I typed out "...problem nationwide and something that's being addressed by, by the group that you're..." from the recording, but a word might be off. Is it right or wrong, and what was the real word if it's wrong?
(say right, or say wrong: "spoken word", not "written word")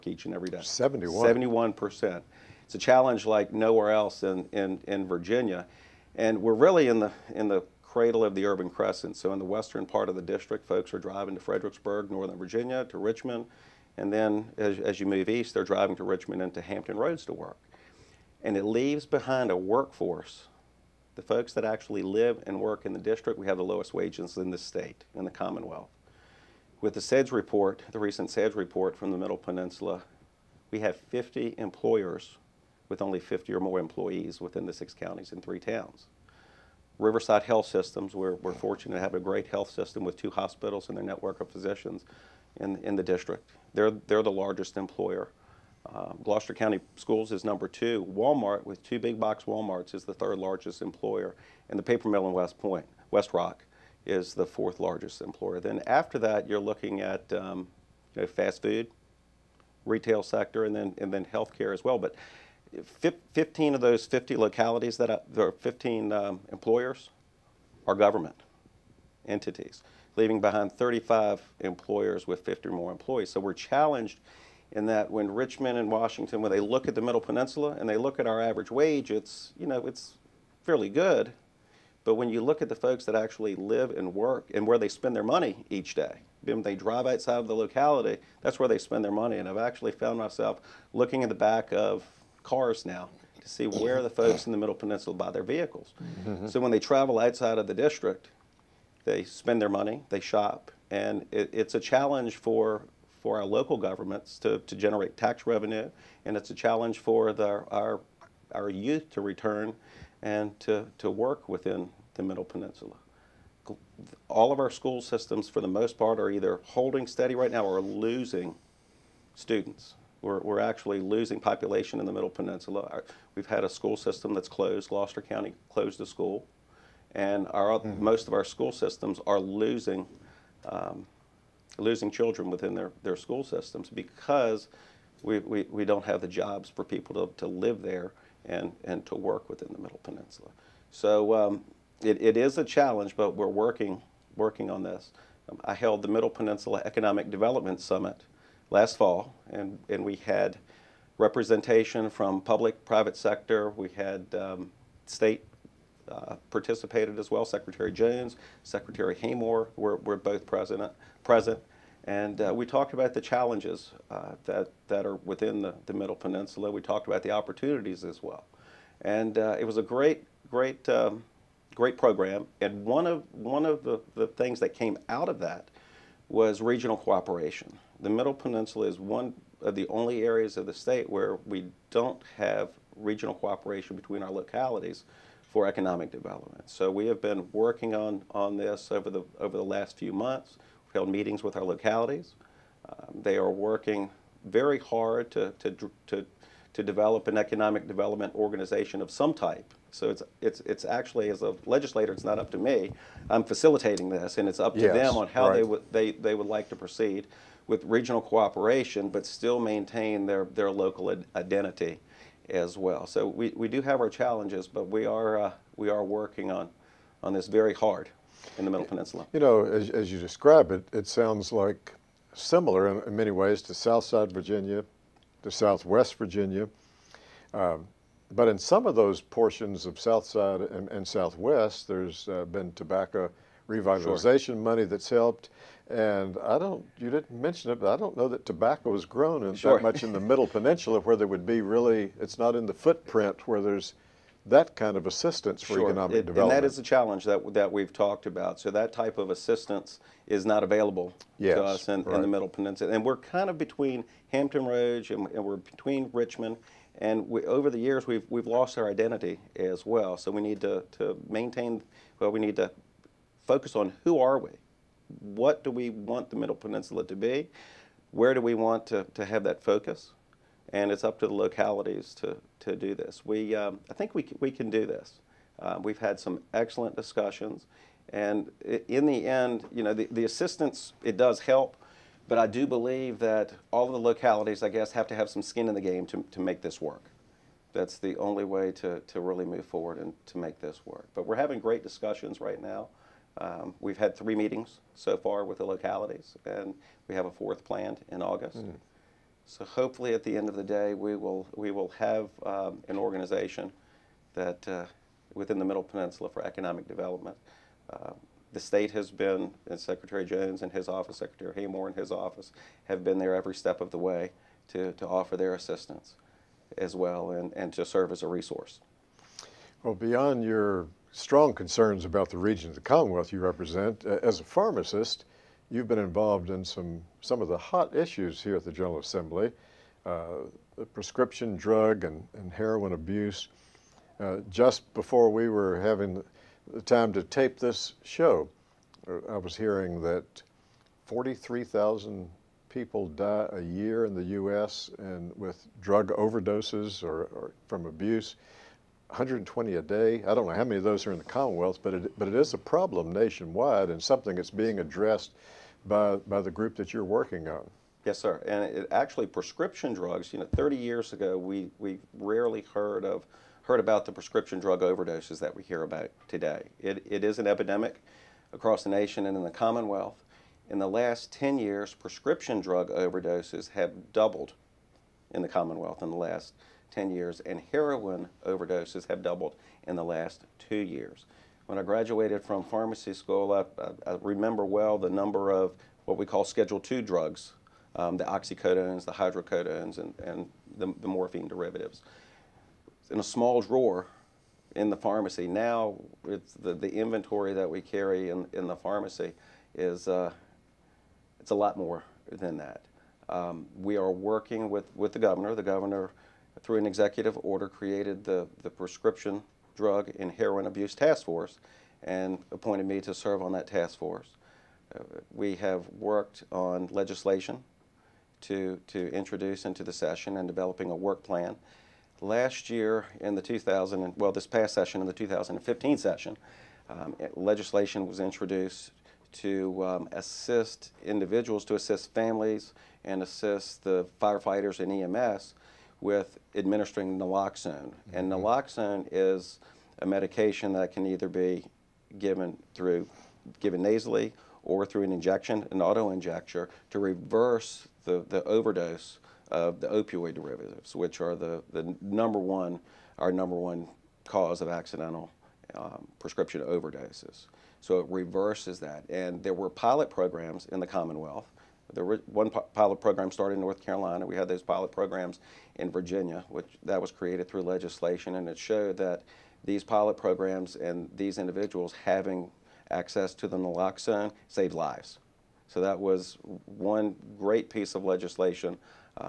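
right.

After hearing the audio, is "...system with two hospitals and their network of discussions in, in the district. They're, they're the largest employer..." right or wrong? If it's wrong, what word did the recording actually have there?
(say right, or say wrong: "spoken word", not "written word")
wrong: "physicians", not "discussions".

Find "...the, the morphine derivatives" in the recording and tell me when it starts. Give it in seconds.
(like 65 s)
390 s.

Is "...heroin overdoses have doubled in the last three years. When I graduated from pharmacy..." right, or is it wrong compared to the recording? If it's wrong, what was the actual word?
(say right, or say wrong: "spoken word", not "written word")
wrong: "two", not "three".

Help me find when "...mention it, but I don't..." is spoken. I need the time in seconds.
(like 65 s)
237 s.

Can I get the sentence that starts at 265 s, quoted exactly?
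what do we want the Middle Peninsula to be?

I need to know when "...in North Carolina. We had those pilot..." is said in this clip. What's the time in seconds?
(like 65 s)
463 s.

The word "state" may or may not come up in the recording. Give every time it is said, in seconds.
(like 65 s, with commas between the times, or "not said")
24 s, 155 s, 180 s, 308 s.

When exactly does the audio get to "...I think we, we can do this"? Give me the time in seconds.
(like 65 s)
273 s.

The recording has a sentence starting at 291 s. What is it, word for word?
But we're having great discussions right now.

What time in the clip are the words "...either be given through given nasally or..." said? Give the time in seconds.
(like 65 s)
441 s.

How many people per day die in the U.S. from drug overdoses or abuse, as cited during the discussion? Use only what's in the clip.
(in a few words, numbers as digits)
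120.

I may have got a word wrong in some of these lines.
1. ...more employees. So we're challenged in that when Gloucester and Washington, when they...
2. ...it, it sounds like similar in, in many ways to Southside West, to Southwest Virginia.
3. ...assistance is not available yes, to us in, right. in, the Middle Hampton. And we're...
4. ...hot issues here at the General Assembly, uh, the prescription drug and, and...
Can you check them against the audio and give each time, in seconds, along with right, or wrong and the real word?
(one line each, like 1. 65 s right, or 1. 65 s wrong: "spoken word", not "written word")
1. 72 s wrong: "Richmond", not "Gloucester"
2. 220 s wrong: "Virginia", not "West"
3. 249 s wrong: "Peninsula", not "Hampton"
4. 327 s right.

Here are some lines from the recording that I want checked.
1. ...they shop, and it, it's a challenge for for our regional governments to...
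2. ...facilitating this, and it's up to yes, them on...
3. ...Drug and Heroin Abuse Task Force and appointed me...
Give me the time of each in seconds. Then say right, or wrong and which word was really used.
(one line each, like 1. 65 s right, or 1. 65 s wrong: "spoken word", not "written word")
1. 100 s wrong: "local", not "regional"
2. 203 s right
3. 409 s right.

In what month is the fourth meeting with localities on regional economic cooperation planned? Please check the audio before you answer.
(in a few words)
August.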